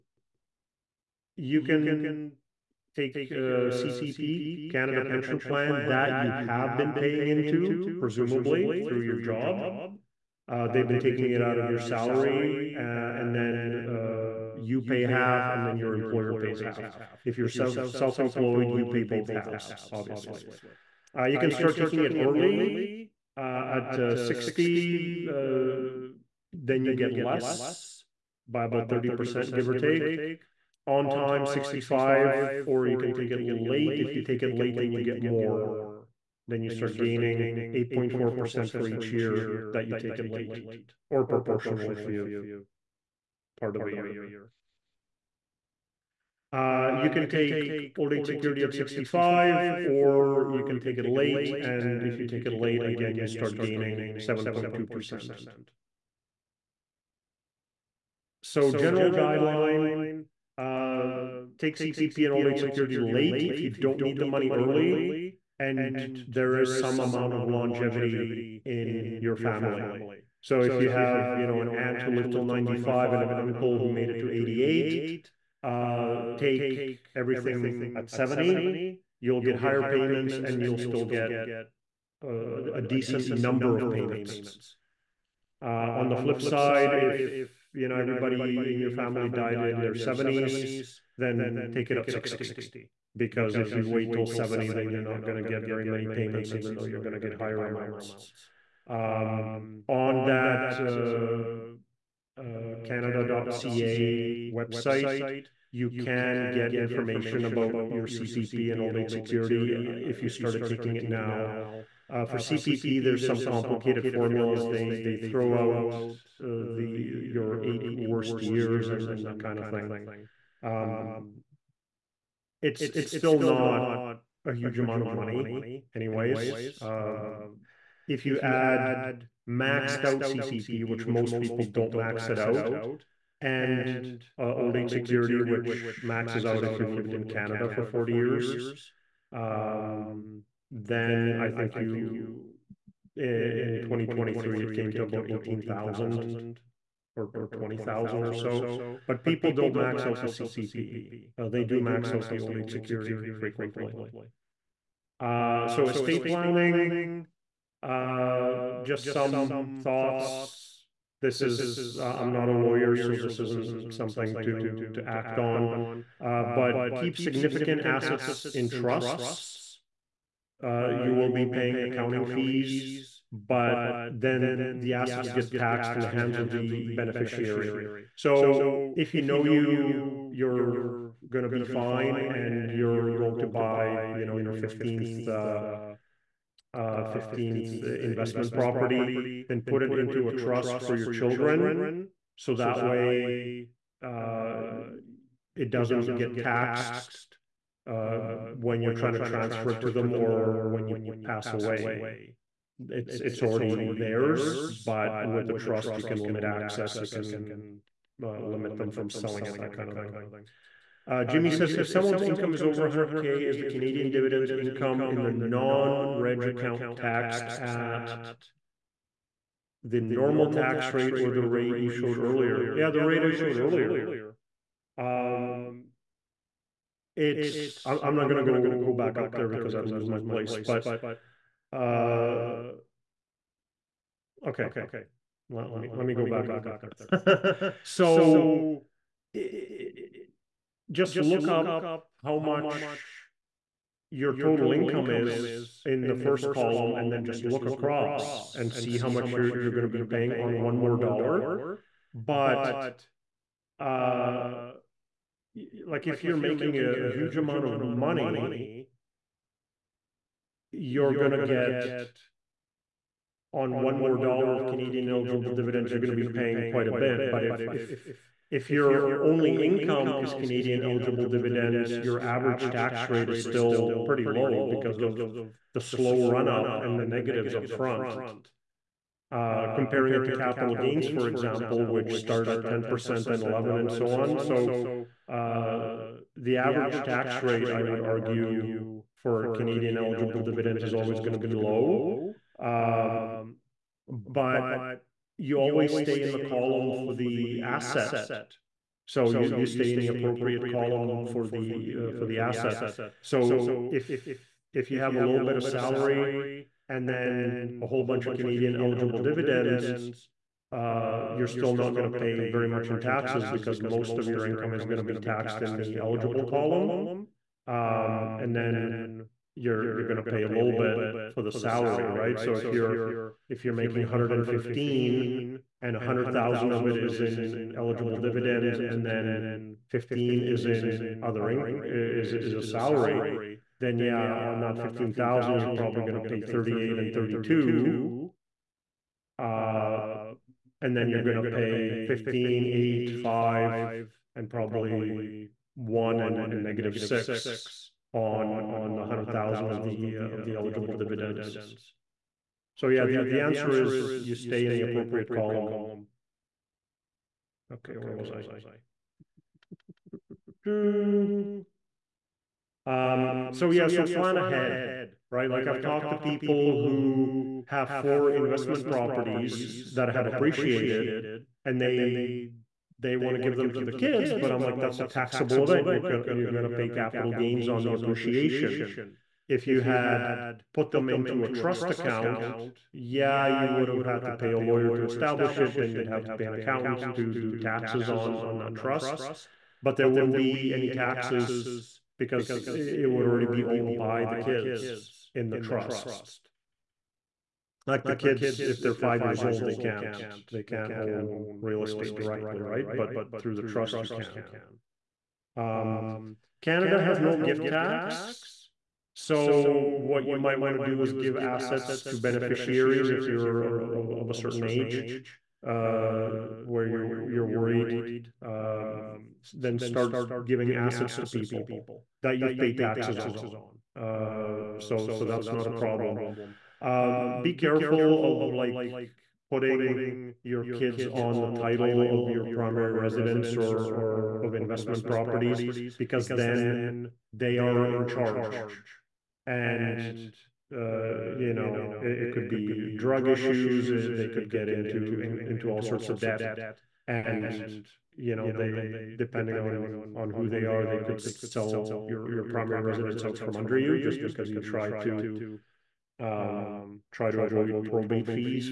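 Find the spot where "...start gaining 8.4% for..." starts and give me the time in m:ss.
0:36.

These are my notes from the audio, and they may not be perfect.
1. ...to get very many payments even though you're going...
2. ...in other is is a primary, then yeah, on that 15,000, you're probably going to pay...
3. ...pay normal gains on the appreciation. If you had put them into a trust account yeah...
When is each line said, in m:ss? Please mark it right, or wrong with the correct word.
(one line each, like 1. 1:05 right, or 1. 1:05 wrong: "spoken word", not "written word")
1. 1:35 right
2. 5:30 wrong: "salary", not "primary"
3. 6:16 wrong: "capital", not "normal".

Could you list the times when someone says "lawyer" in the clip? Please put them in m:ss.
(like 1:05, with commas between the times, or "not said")
2:42, 6:24.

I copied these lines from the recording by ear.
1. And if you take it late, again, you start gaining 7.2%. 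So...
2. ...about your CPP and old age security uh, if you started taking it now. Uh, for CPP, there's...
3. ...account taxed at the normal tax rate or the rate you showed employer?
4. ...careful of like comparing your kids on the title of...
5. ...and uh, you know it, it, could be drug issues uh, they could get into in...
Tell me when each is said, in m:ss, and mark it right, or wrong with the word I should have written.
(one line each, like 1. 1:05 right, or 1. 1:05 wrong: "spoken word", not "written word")
1. 0:51 right
2. 1:47 right
3. 3:36 wrong: "earlier", not "employer"
4. 7:07 wrong: "putting", not "comparing"
5. 7:19 right.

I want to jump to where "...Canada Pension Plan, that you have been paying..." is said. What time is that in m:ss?
0:04.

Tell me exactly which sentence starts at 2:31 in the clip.
Uh, they do max out the old age security frequently.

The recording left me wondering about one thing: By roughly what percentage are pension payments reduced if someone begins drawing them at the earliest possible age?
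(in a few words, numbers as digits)
30%.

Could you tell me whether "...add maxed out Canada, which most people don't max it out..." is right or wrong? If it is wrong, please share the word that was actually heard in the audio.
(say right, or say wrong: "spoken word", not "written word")
wrong: "CPP", not "Canada".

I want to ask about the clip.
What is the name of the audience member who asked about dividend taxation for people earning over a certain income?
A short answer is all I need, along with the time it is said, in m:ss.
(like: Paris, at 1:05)
Jimmy, at 3:31.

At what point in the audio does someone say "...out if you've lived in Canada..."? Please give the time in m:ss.
2:16.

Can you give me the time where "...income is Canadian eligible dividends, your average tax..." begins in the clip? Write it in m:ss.
4:29.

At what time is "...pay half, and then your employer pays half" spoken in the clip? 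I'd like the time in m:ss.
0:14.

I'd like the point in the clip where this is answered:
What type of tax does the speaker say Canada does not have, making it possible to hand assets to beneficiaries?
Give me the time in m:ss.
6:47.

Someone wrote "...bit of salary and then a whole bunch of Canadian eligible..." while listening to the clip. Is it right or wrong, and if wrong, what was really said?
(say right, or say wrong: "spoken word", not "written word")
right.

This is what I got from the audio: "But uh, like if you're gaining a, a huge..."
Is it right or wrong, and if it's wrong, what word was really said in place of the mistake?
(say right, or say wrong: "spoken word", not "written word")
wrong: "making", not "gaining".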